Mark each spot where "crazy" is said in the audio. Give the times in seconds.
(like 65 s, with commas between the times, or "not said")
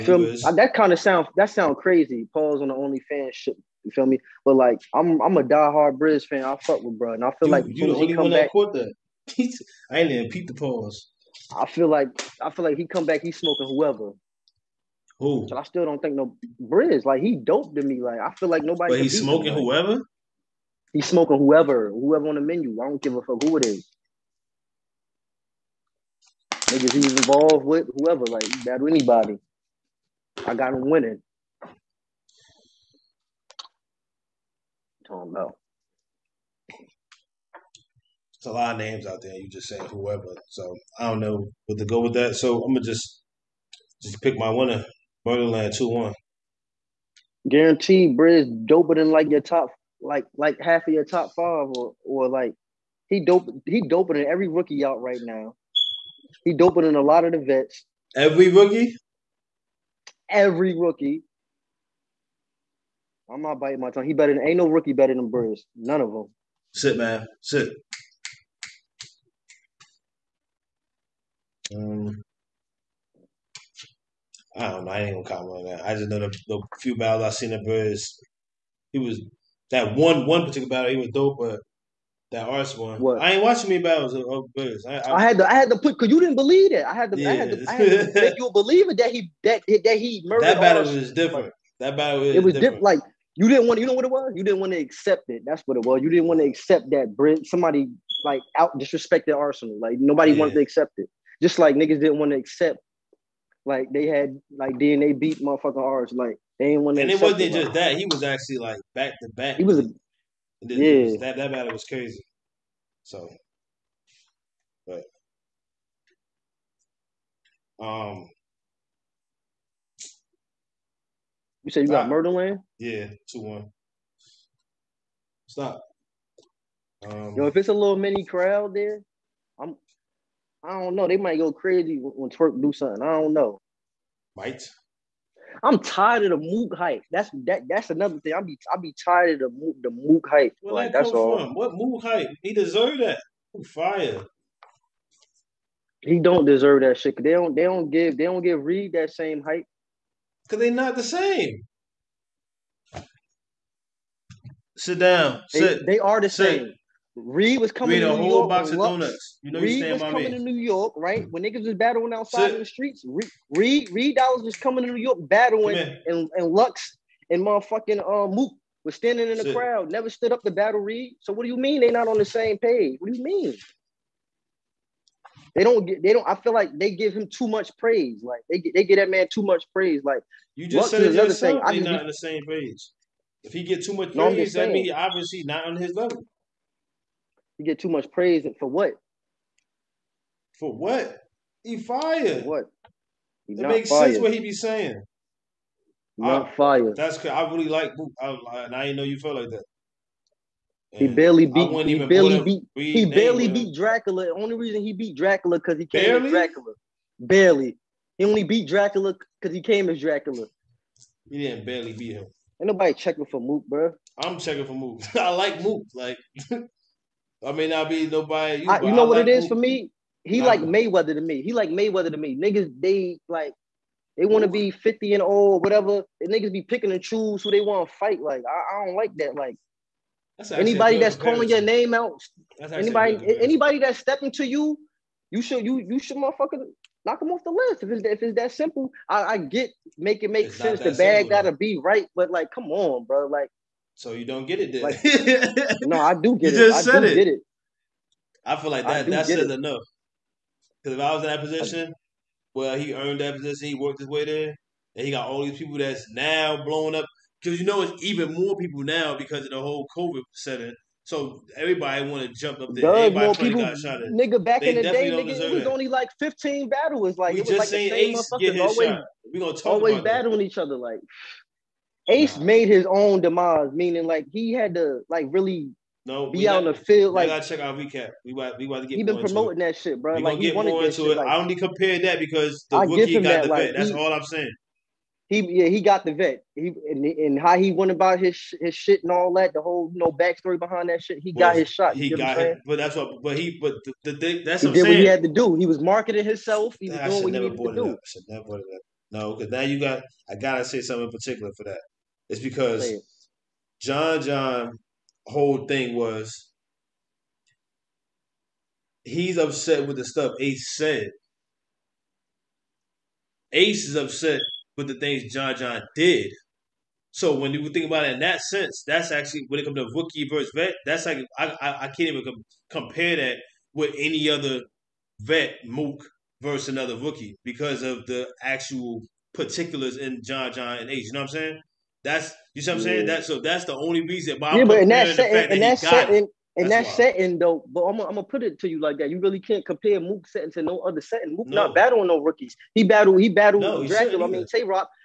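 1 s, 111 s, 131 s.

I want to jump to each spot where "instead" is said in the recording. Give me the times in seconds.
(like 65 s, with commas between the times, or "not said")
not said.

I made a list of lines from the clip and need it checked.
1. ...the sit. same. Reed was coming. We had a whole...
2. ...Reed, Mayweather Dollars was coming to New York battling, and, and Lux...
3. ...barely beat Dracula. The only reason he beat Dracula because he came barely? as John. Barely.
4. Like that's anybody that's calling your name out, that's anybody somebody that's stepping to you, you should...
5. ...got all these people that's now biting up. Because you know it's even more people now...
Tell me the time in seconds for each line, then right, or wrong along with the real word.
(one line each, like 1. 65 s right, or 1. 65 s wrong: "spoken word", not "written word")
1. 156 s right
2. 163 s wrong: "Dallas", not "Mayweather"
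3. 203 s wrong: "Dracula", not "John"
4. 229 s wrong: "anybody", not "somebody"
5. 255 s wrong: "blowing", not "biting".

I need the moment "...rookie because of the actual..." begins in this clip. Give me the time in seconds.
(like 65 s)
326 s.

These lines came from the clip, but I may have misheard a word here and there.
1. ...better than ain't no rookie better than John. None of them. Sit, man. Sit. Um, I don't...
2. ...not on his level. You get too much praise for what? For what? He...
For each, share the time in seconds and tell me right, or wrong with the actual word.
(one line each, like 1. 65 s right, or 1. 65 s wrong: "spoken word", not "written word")
1. 64 s wrong: "Brizz", not "John"
2. 185 s right.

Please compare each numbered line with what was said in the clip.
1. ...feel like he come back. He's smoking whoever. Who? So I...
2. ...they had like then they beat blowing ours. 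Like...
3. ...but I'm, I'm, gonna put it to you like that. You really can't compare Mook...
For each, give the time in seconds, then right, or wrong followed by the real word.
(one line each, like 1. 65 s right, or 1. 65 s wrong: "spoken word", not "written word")
1. 12 s right
2. 103 s wrong: "motherfucking", not "blowing"
3. 337 s right.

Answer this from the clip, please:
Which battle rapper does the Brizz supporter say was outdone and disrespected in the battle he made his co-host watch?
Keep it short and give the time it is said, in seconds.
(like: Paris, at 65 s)
Arsonal, at 99 s.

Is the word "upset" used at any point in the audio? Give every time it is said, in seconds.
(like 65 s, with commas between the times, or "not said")
309 s, 313 s.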